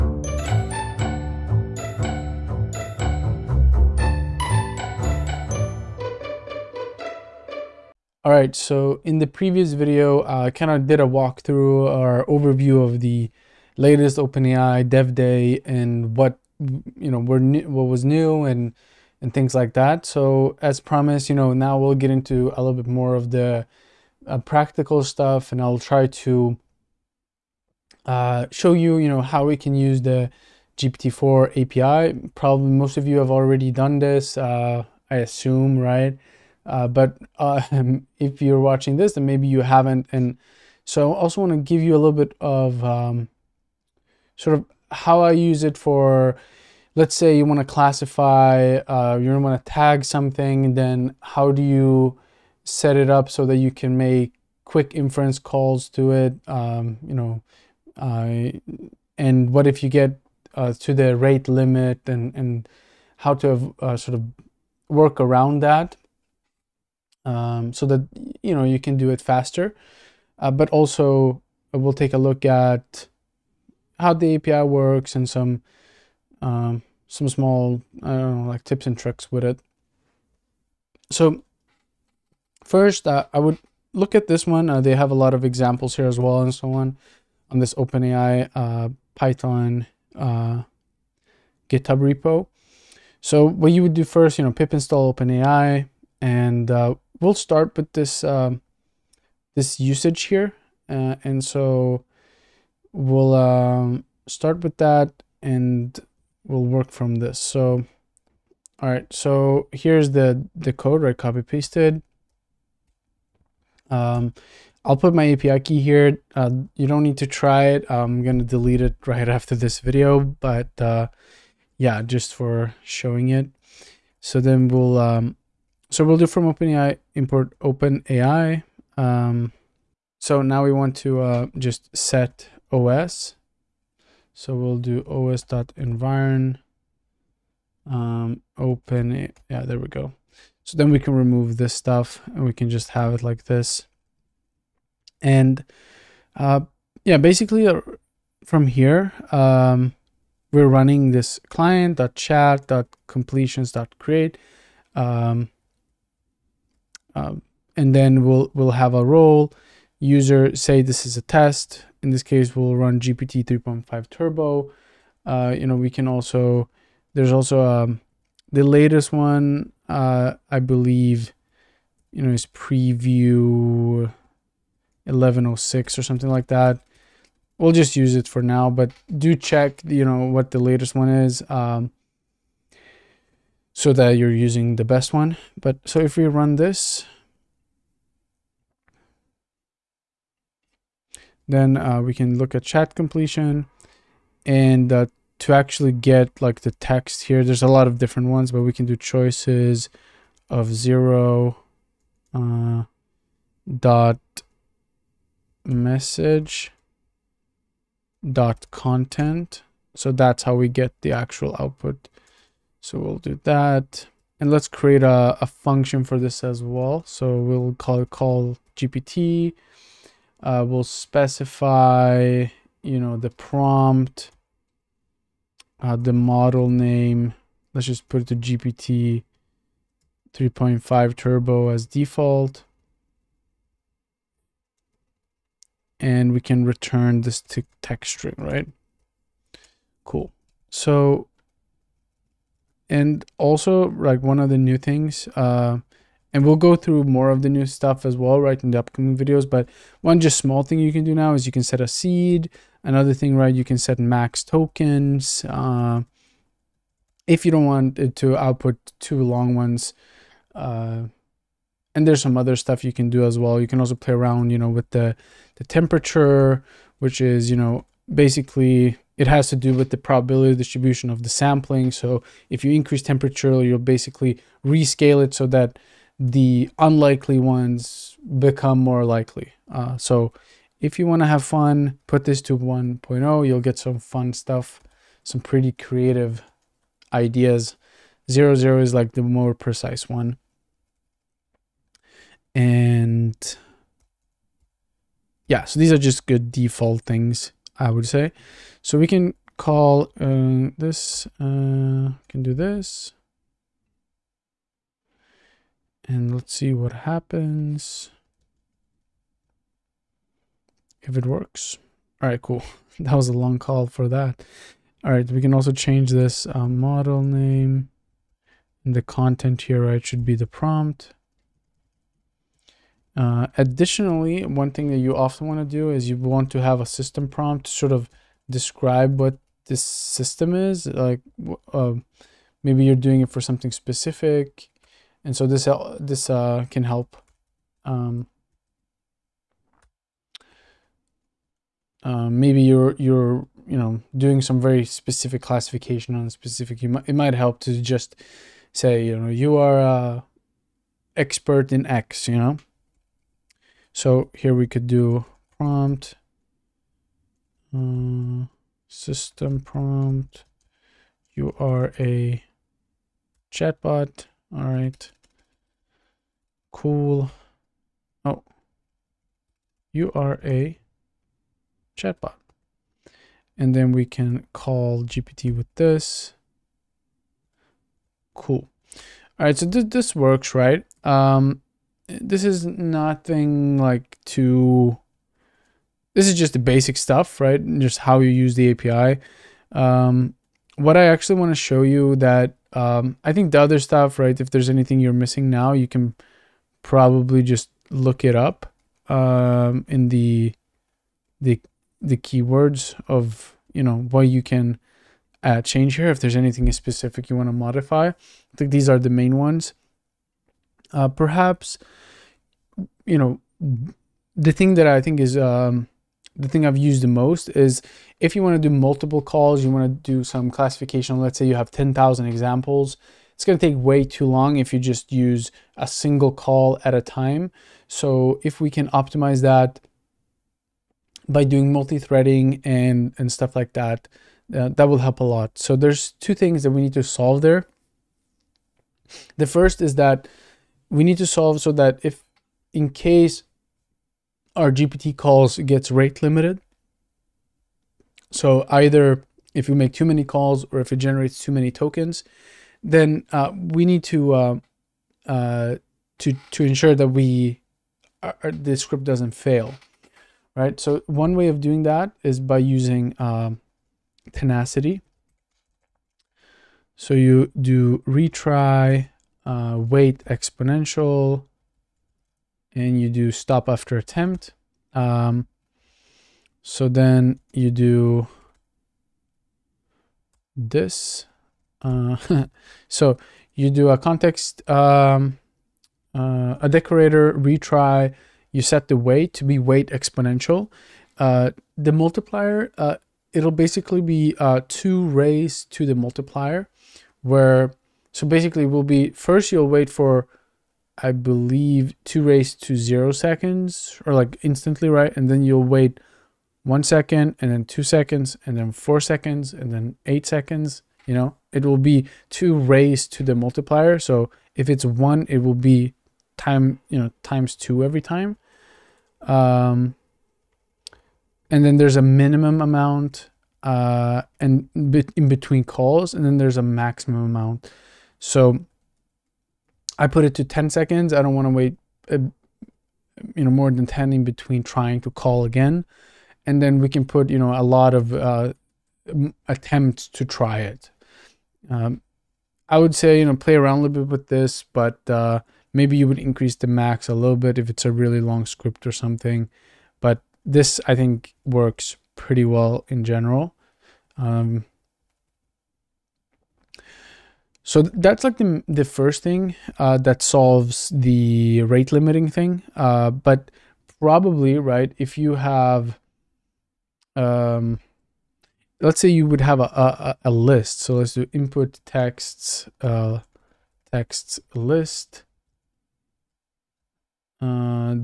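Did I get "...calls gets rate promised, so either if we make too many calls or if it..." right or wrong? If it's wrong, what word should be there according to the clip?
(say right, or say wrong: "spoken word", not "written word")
wrong: "limited", not "promised".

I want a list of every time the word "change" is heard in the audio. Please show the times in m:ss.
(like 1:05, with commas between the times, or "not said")
5:15, 6:45.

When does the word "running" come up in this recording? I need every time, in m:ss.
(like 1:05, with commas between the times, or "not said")
2:30.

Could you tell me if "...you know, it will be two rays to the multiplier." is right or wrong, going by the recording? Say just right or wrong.
right.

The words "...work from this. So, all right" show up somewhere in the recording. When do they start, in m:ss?
1:46.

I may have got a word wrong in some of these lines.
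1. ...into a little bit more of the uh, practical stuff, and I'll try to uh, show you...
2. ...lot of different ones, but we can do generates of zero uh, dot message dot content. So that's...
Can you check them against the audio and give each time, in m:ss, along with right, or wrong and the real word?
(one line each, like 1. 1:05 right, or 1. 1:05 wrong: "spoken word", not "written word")
1. 0:22 right
2. 3:17 wrong: "choices", not "generates".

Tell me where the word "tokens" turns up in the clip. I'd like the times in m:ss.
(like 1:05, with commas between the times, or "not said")
4:14, 7:31.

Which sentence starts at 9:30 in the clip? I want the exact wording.
So let's do input texts, uh, texts list.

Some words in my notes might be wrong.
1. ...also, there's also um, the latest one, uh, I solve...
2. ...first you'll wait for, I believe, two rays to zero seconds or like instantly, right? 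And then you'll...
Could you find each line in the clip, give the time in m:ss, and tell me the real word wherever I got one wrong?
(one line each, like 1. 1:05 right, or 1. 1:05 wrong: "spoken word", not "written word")
1. 2:46 wrong: "believe", not "solve"
2. 8:19 right.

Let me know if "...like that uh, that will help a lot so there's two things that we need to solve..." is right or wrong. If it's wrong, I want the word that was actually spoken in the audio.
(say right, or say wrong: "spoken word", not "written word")
right.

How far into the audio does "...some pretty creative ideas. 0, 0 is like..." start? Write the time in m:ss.
4:45.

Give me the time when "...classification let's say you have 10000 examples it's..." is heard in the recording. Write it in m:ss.
7:00.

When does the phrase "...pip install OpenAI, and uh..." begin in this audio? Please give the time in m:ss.
1:34.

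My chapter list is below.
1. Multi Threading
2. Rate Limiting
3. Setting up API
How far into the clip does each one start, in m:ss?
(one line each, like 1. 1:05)
1. 9:25
2. 7:14
3. 1:21.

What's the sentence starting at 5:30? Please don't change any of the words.
Like uh, maybe you're doing it for something specific, and so this this uh, can help.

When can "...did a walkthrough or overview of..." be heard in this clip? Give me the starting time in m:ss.
0:10.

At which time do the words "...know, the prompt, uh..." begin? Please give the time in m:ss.
3:42.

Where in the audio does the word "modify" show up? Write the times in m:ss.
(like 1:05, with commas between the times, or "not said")
6:47.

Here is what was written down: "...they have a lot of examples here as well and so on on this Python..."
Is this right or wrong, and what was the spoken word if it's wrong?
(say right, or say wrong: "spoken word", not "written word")
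wrong: "OpenAI", not "Python".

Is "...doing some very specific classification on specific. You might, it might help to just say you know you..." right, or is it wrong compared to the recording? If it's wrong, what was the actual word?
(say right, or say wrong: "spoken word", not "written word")
right.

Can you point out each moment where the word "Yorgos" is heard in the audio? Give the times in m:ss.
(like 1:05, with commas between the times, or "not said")
not said.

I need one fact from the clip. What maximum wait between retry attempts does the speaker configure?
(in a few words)
10 seconds.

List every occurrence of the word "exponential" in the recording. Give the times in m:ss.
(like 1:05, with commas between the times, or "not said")
7:50, 8:09.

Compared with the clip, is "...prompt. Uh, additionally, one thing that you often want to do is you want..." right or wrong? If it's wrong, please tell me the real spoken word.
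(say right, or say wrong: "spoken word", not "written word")
right.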